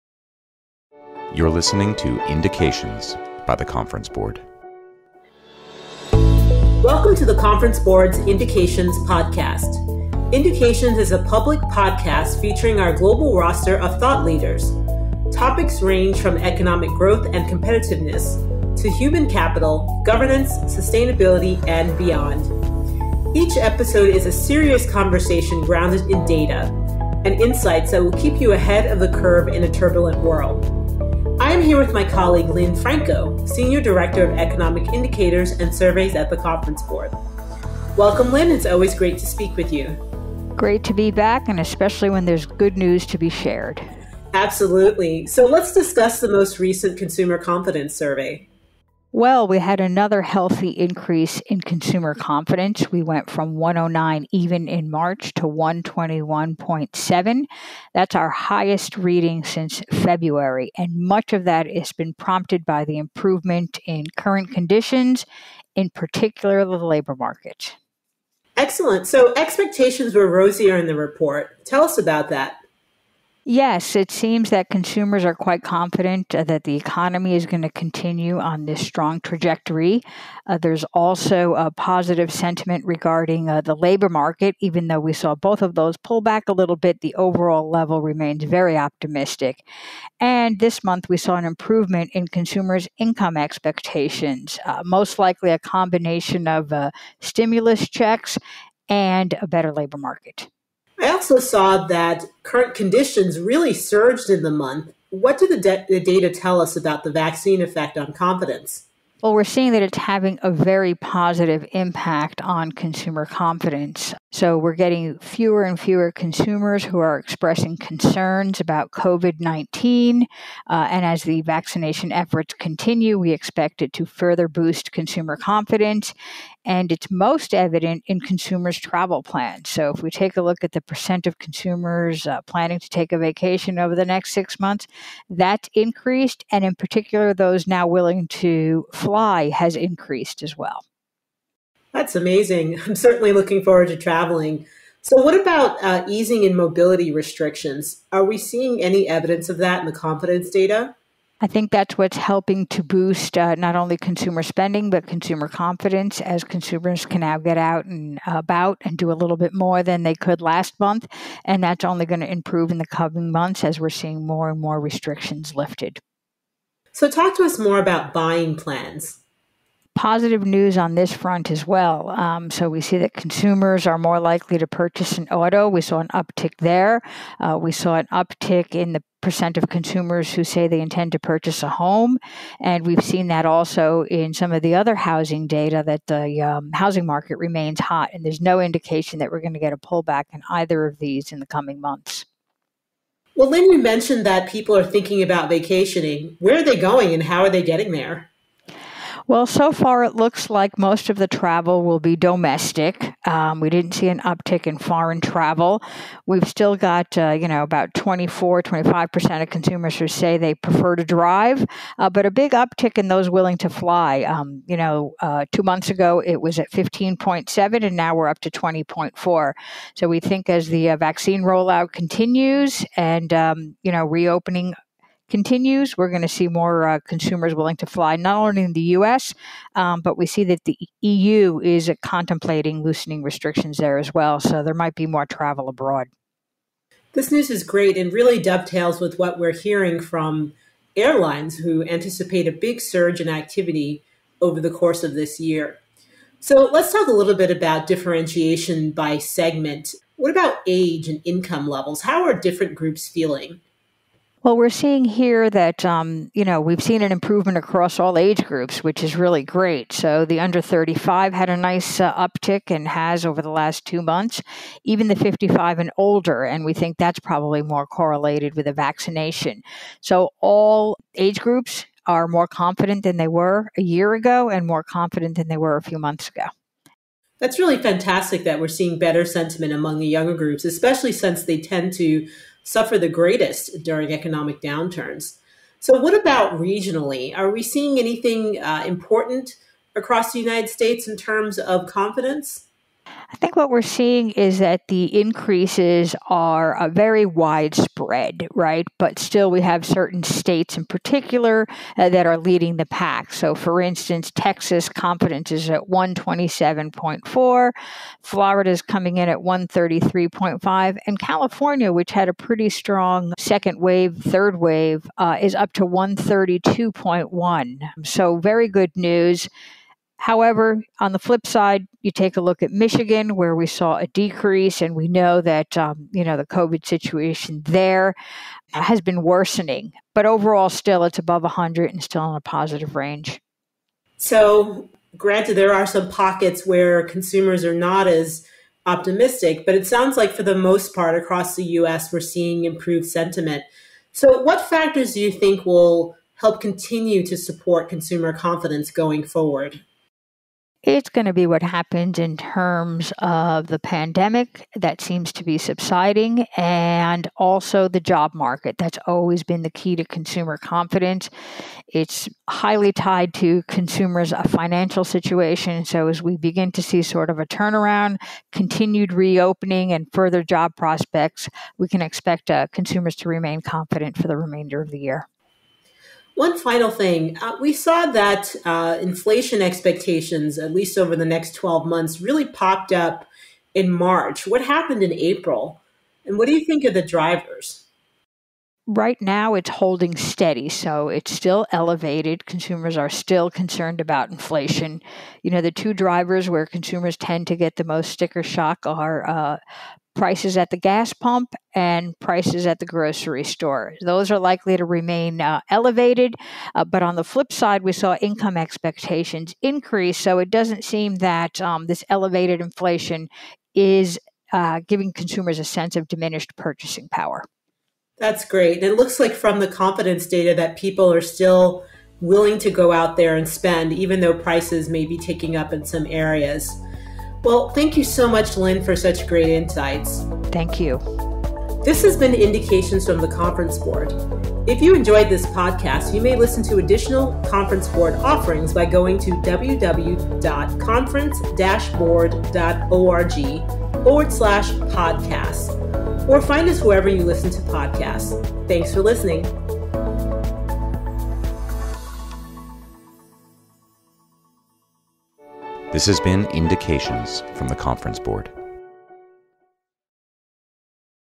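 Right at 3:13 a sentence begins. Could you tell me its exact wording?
Well, Lynn, you mentioned that people are thinking about vacationing.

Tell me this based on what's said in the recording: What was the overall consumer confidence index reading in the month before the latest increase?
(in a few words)
109.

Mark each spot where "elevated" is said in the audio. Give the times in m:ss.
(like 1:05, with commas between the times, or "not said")
6:31, 6:45, 6:52.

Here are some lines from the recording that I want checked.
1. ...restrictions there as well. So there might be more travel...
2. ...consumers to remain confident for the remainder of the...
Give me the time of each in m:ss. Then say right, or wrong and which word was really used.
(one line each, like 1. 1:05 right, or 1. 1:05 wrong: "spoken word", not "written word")
1. 3:53 right
2. 6:12 right.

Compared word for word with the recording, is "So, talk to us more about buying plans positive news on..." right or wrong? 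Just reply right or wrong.
right.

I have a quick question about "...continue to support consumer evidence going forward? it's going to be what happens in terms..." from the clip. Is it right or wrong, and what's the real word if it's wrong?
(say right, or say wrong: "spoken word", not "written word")
wrong: "confidence", not "evidence".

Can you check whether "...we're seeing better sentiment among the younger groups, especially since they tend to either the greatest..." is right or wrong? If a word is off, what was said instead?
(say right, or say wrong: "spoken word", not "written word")
wrong: "suffer", not "either".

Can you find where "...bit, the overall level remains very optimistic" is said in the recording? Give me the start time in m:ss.
1:26.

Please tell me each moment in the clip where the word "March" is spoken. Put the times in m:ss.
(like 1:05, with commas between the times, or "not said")
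0:54, 6:23.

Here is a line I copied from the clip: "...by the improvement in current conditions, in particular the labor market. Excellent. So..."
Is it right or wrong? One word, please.
right.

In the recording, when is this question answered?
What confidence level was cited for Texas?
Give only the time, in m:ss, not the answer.
5:05.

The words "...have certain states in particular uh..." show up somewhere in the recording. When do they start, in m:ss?
4:59.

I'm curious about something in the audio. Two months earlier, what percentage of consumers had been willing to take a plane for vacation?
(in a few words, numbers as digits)
15.7.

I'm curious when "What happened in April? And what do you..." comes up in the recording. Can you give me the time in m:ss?
6:24.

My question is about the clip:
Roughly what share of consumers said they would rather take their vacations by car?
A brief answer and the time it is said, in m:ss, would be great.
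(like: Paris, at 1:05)
24-25%, at 3:27.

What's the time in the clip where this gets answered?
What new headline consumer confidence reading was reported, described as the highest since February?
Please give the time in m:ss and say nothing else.
0:55.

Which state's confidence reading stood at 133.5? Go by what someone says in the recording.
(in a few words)
Florida.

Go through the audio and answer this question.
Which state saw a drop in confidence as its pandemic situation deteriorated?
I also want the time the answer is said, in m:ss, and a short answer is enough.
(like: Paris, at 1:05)
Michigan, at 5:22.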